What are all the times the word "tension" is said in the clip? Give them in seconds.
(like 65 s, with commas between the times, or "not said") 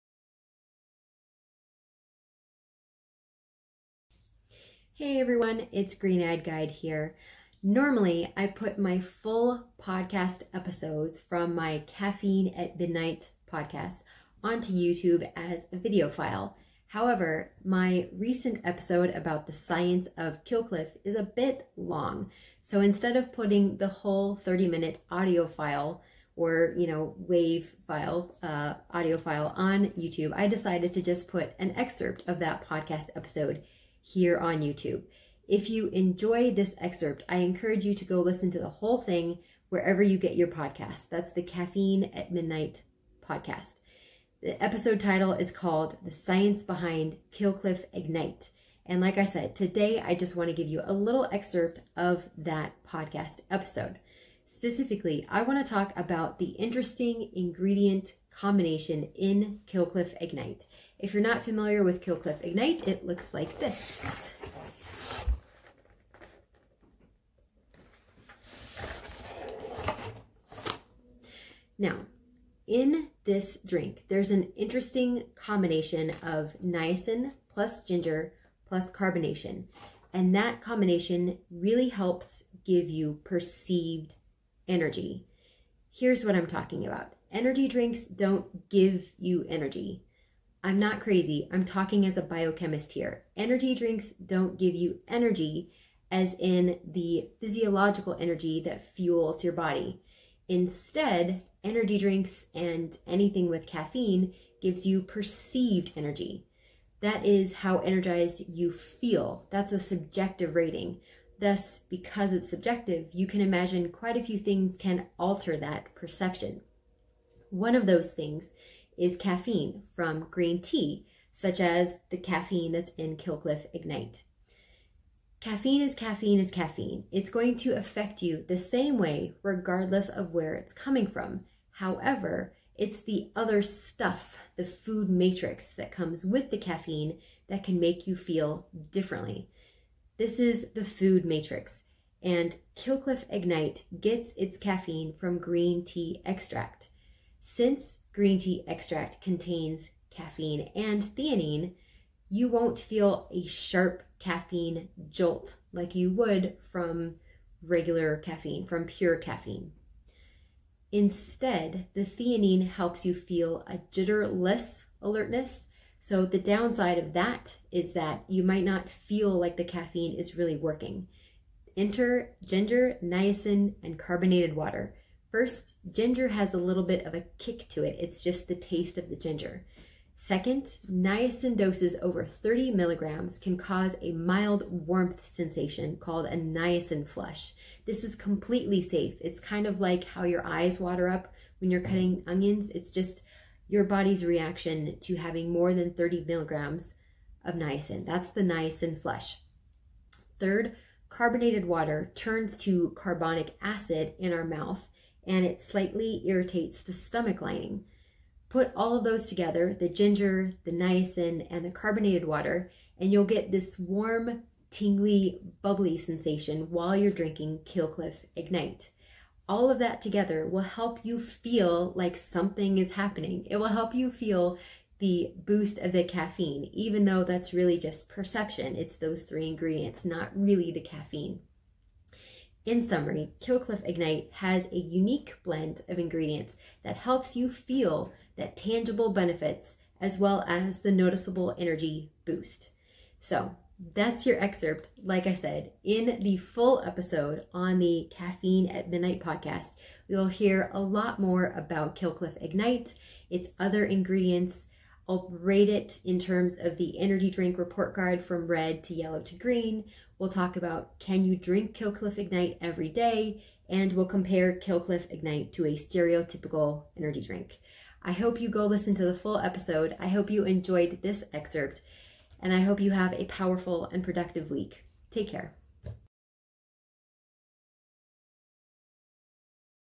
not said.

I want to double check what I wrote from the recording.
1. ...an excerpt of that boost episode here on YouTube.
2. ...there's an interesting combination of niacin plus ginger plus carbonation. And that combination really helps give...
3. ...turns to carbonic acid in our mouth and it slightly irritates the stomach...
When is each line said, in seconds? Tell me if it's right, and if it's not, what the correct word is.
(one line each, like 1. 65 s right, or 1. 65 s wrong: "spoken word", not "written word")
1. 31 s wrong: "podcast", not "boost"
2. 74 s right
3. 202 s right.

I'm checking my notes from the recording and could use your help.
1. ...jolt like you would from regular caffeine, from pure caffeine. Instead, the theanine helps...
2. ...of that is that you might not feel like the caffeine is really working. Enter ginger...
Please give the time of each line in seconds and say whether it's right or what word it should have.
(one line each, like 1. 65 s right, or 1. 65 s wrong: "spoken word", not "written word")
1. 155 s right
2. 166 s right.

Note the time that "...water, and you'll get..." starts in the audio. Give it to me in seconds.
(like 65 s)
212 s.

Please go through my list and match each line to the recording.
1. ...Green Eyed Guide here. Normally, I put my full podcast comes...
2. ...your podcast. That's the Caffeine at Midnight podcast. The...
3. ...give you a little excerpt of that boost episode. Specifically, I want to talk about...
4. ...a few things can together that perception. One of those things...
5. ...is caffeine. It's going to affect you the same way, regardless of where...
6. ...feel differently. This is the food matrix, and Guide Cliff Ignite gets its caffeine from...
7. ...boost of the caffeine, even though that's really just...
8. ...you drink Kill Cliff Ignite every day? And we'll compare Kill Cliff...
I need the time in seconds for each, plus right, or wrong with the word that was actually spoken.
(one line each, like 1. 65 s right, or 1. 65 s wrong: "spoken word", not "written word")
1. 5 s wrong: "episodes", not "comes"
2. 40 s right
3. 50 s wrong: "podcast", not "boost"
4. 114 s wrong: "alter", not "together"
5. 126 s right
6. 138 s wrong: "Kill", not "Guide"
7. 225 s right
8. 261 s right.